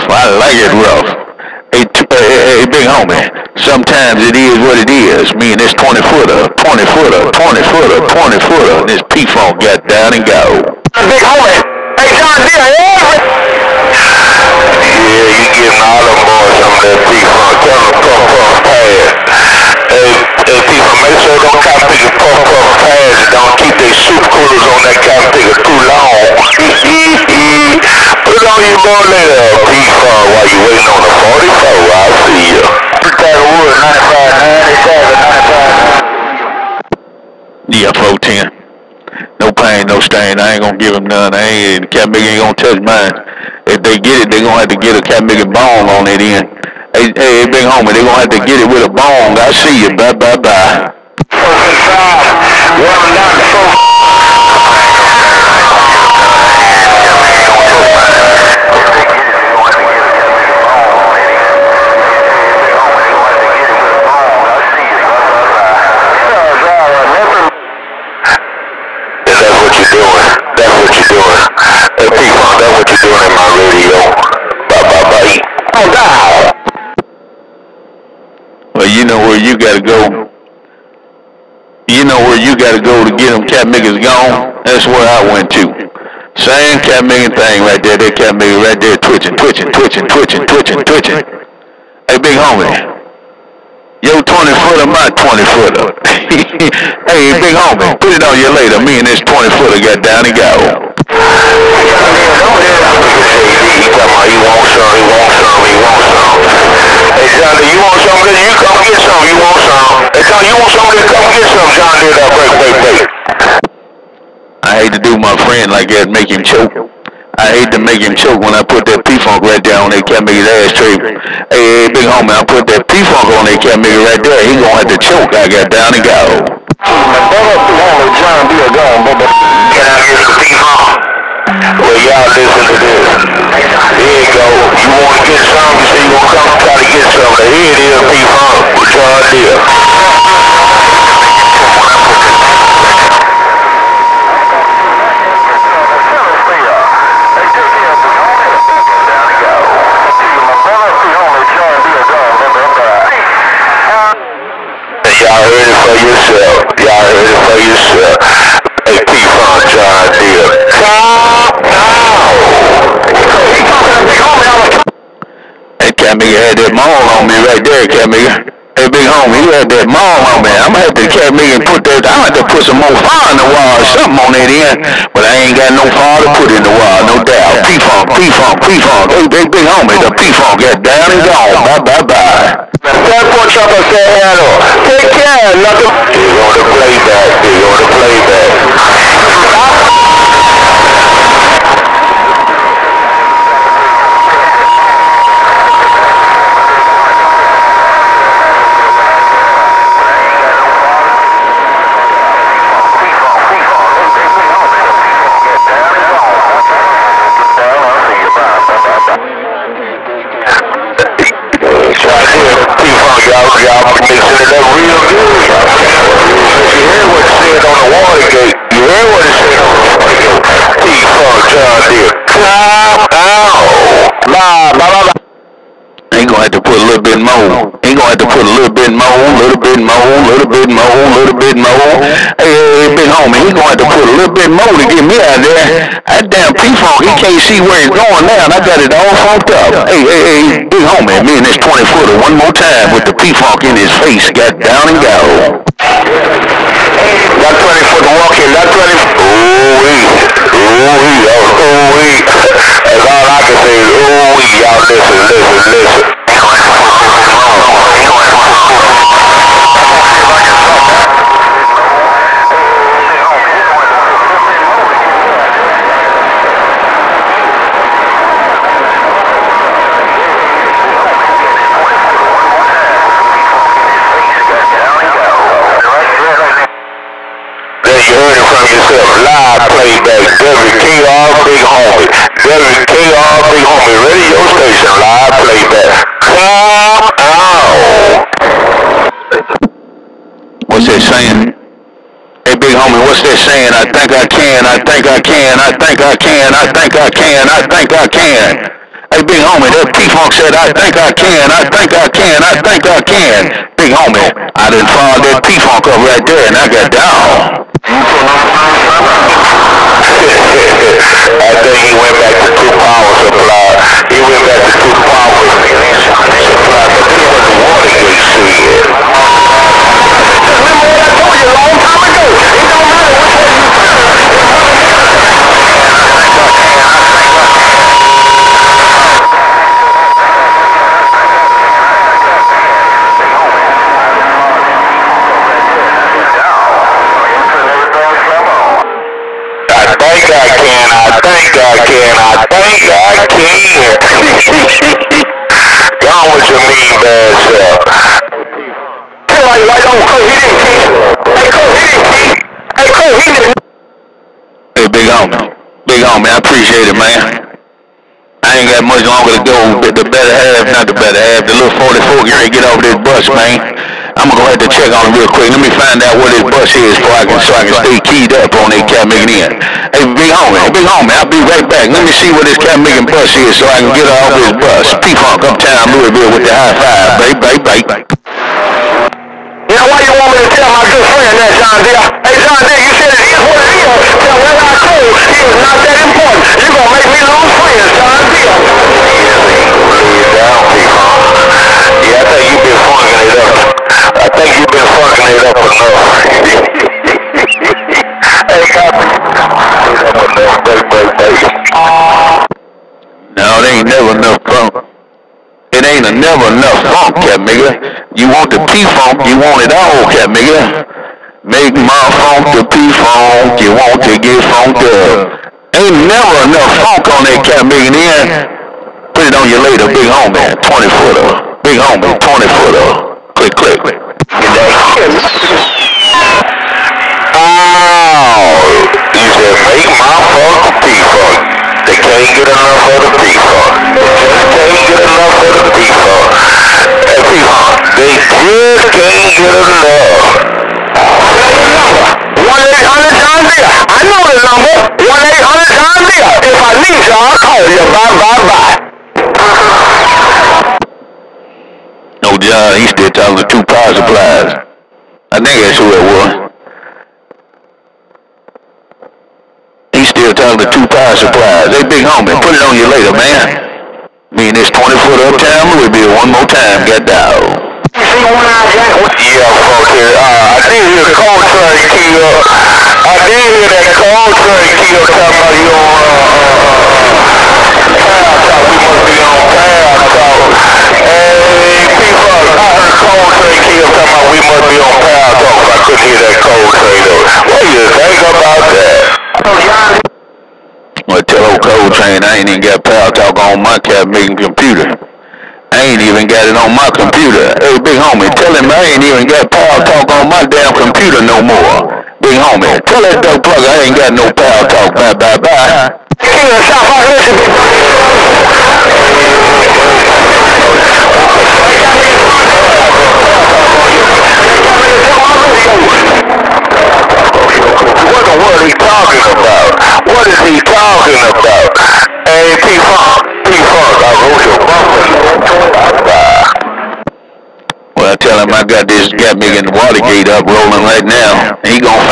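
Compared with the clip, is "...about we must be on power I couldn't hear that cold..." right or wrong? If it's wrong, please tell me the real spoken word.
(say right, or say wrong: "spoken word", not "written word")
right.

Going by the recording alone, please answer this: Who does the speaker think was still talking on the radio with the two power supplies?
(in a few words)
John Easton.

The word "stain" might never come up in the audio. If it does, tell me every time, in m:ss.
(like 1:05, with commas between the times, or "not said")
0:39.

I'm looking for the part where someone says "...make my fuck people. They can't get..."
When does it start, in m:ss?
7:09.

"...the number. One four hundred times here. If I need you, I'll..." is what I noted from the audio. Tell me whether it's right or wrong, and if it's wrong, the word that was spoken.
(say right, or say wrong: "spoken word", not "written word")
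wrong: "eight", not "four".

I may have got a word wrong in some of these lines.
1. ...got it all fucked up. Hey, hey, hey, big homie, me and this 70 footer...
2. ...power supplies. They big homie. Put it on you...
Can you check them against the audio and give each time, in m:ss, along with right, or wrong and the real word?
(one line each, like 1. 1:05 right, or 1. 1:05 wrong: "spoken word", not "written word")
1. 3:58 wrong: "20", not "70"
2. 7:40 right.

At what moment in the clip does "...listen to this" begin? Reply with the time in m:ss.
2:12.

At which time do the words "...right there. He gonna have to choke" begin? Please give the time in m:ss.
2:04.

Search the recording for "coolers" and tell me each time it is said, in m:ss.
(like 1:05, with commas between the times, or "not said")
0:24.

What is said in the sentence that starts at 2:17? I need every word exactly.
Now, here it is, P-Funk, with John Deere.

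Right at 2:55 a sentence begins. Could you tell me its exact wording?
But I ain't got no fire to put in the wall, no doubt.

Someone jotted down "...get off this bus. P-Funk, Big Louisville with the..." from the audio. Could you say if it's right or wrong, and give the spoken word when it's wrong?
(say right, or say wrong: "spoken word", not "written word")
wrong: "Uptown", not "Big".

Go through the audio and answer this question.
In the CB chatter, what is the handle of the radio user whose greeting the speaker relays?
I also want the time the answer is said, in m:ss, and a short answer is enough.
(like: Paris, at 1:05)
Chopper, at 3:03.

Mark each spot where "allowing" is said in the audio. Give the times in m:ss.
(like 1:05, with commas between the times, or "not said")
not said.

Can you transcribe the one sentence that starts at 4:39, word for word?
I played that Desert KR Big Homie.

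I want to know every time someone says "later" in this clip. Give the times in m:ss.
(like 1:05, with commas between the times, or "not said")
1:38, 6:59, 7:42.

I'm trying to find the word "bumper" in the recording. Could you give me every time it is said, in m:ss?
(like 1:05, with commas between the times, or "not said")
8:44.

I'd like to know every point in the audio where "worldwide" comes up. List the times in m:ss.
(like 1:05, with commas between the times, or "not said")
not said.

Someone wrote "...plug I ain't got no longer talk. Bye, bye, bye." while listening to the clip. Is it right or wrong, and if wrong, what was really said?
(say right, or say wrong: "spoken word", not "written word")
wrong: "power", not "longer".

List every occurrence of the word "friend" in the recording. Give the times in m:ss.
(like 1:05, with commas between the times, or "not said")
1:55, 6:21, 6:27.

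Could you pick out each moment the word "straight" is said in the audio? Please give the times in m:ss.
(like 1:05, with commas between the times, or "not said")
2:00.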